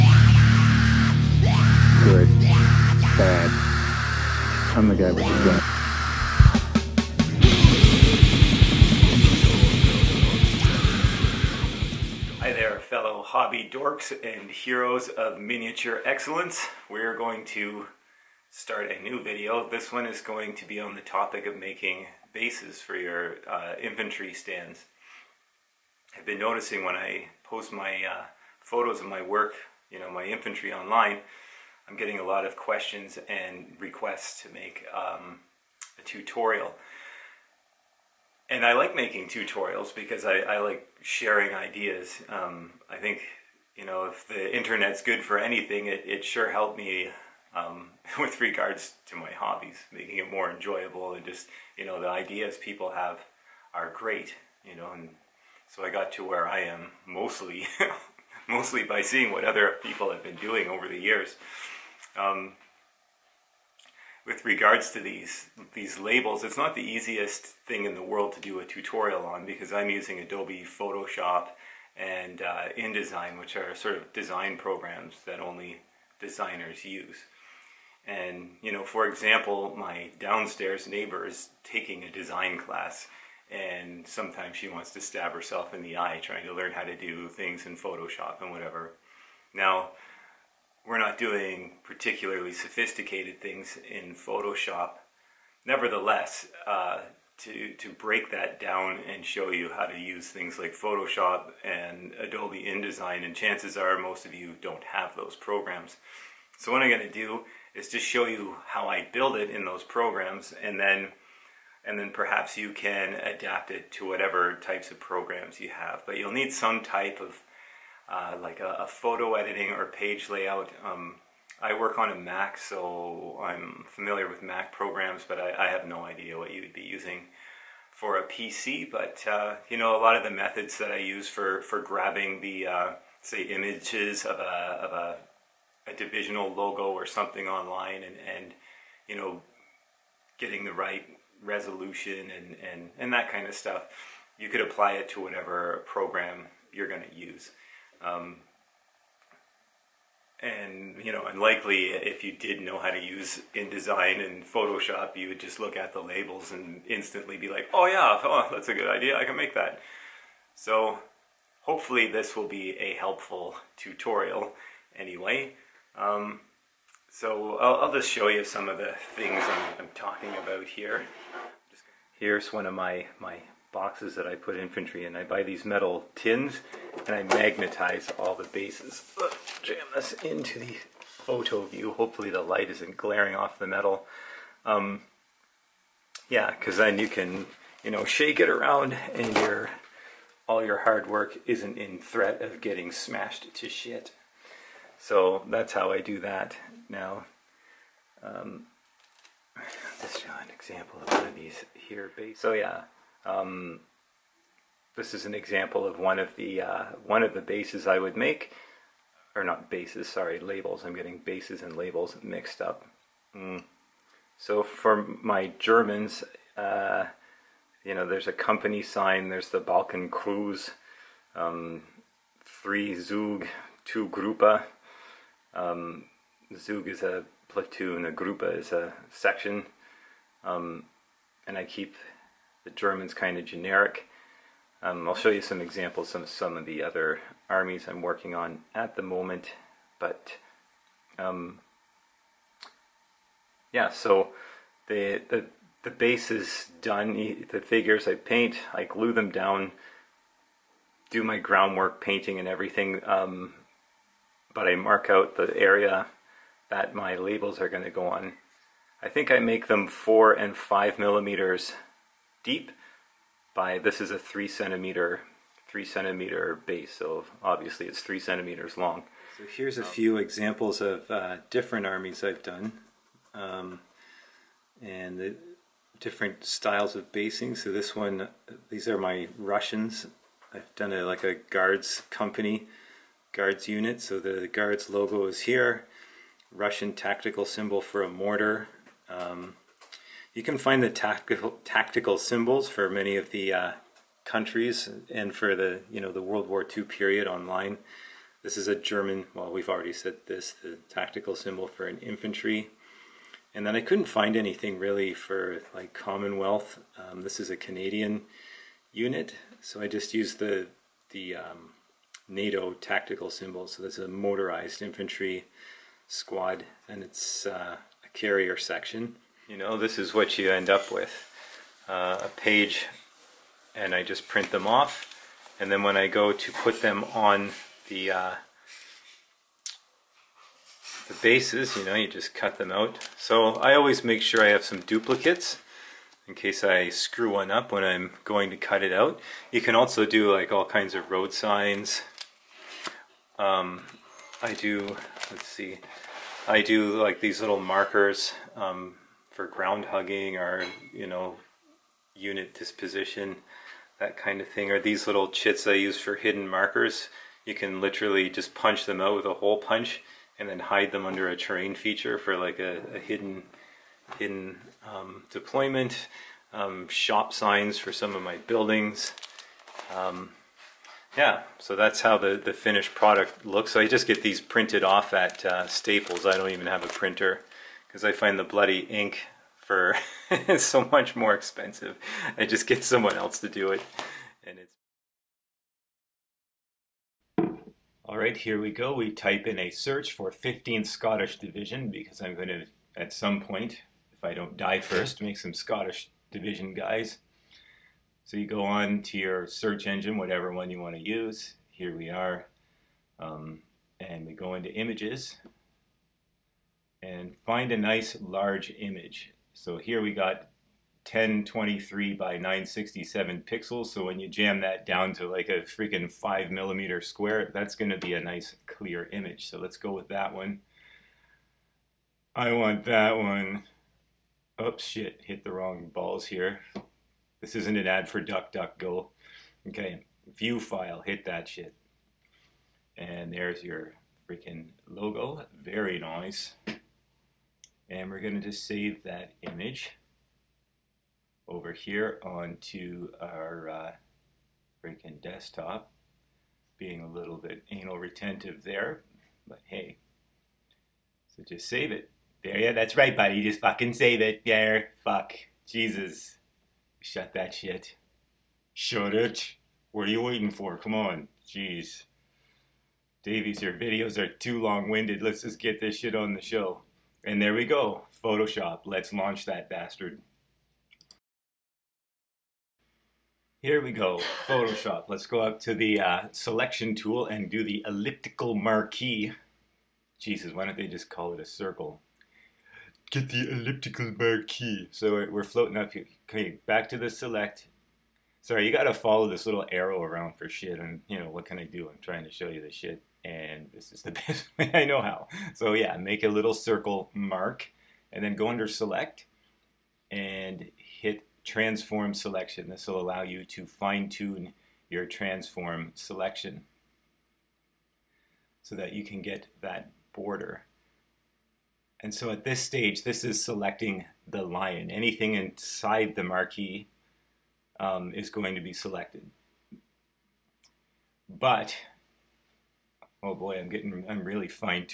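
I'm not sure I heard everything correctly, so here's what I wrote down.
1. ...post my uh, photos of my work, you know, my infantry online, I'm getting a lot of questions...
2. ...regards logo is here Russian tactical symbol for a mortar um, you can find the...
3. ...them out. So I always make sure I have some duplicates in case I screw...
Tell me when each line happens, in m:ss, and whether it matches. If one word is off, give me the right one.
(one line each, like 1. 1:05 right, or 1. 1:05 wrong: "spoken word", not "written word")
1. 0:27 right
2. 4:44 wrong: "guards", not "regards"
3. 5:32 right.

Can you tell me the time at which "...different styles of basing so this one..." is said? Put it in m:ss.
4:35.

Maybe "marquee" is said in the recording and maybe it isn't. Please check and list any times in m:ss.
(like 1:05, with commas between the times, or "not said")
7:58, 8:04, 8:36.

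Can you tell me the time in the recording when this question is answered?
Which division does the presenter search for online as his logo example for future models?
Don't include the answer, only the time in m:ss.
6:30.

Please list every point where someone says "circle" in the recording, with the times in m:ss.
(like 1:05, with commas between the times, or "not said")
8:01, 8:16.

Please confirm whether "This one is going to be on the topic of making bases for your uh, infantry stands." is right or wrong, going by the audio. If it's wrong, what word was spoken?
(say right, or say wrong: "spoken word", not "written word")
right.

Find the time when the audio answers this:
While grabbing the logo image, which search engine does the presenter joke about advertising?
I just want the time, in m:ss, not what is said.
7:08.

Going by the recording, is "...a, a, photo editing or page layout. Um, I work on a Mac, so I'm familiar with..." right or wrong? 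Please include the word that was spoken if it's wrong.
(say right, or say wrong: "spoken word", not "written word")
right.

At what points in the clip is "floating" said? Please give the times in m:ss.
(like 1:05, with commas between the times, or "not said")
8:05.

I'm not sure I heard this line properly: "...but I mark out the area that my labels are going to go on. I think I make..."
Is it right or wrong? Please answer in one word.
right.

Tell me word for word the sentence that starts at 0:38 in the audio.
And I like making tutorials because I, I like sharing ideas.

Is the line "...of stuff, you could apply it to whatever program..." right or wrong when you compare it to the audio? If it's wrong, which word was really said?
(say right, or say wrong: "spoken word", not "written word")
right.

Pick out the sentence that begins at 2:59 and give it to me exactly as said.
jam this into the photo view.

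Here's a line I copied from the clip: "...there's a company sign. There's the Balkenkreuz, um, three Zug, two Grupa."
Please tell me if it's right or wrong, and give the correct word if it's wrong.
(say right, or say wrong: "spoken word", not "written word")
right.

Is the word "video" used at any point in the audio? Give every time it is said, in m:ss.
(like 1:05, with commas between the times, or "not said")
0:19, 7:43.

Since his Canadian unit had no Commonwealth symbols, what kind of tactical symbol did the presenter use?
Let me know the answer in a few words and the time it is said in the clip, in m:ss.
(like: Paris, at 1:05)
NATO tactical symbol, at 5:12.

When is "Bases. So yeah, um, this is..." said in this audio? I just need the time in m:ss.
3:22.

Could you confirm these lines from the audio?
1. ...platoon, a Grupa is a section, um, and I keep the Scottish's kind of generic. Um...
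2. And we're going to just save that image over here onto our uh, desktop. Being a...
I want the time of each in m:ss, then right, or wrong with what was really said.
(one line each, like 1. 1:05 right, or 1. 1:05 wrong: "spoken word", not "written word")
1. 3:47 wrong: "German", not "Scottish"
2. 7:17 right.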